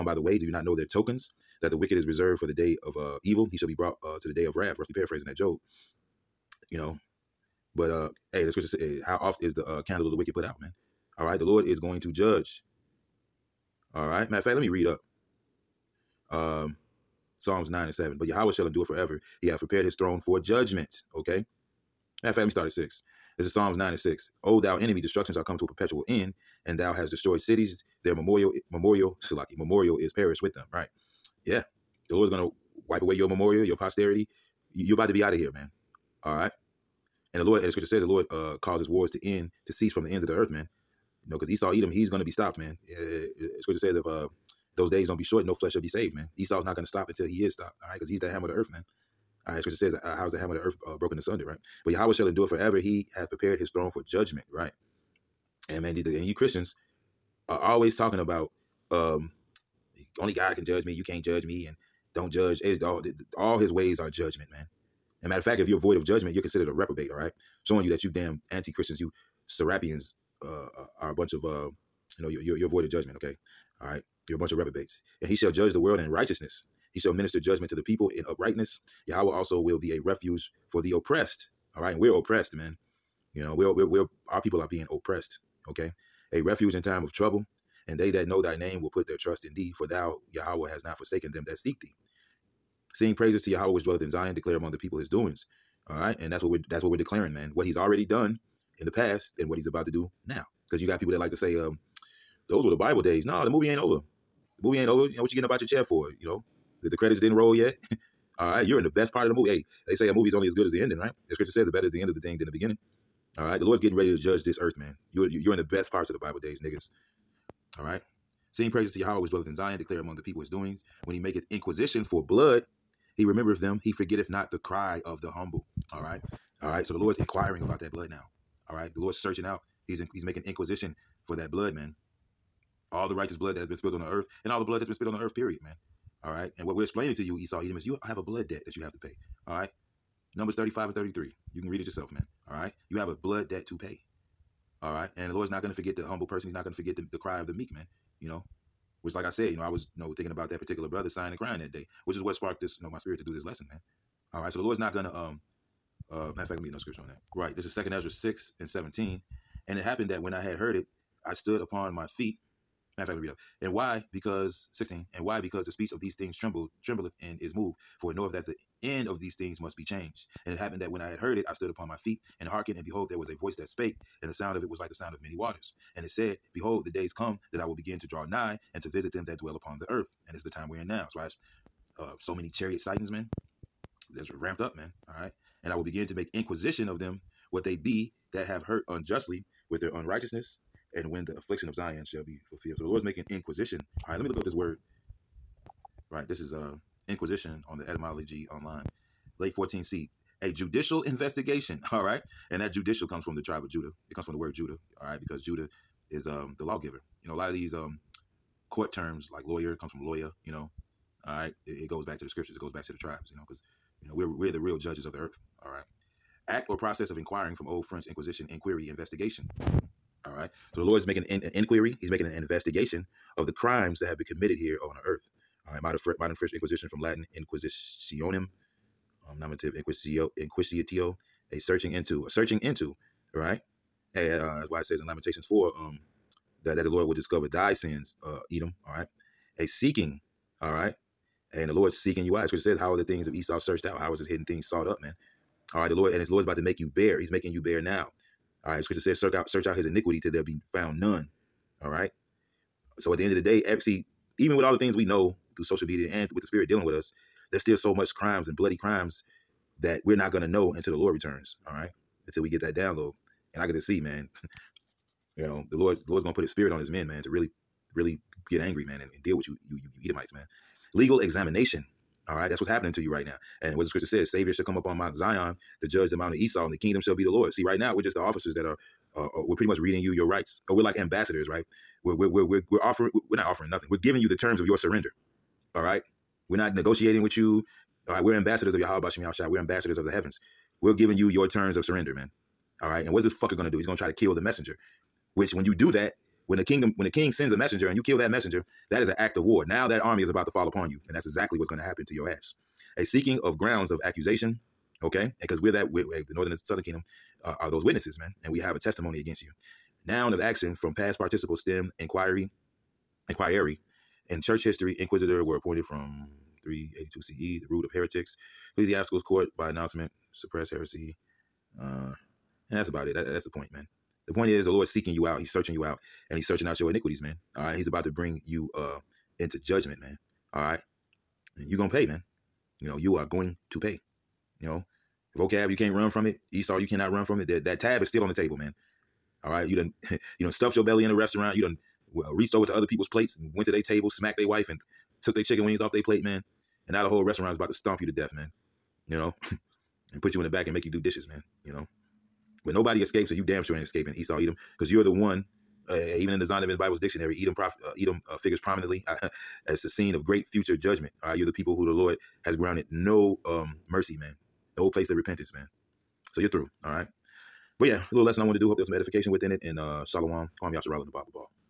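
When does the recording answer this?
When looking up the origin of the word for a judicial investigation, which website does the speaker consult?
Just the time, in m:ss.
3:17.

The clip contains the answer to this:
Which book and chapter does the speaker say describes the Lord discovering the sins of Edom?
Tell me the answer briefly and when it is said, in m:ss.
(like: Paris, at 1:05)
Lamentations 4, at 3:55.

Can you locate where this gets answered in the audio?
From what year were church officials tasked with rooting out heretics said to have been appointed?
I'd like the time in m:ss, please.
5:16.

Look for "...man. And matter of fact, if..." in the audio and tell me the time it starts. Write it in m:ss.
1:04.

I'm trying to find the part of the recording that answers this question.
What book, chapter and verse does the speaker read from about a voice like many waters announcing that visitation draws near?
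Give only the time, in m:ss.
2:37.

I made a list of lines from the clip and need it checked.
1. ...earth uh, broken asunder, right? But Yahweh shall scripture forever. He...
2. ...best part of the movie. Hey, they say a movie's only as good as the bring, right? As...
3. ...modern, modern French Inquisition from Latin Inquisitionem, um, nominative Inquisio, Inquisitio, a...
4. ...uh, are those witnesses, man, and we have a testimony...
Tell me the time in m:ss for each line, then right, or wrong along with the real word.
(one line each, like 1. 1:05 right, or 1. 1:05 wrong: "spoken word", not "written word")
1. 0:50 wrong: "endure", not "scripture"
2. 1:48 wrong: "ending", not "bring"
3. 3:45 right
4. 5:07 right.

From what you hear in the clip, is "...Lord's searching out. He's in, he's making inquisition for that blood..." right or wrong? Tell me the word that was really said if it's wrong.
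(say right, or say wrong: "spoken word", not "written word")
right.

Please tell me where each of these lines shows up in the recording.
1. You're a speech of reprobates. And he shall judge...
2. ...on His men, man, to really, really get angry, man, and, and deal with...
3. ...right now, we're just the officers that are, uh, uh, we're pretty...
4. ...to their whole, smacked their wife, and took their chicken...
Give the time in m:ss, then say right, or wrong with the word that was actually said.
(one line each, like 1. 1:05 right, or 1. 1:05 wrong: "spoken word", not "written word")
1. 1:14 wrong: "bunch", not "speech"
2. 4:26 right
3. 4:37 right
4. 5:43 wrong: "table", not "whole".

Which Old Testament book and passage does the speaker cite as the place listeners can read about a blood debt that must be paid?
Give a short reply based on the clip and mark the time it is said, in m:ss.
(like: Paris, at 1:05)
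Numbers 35:33, at 2:20.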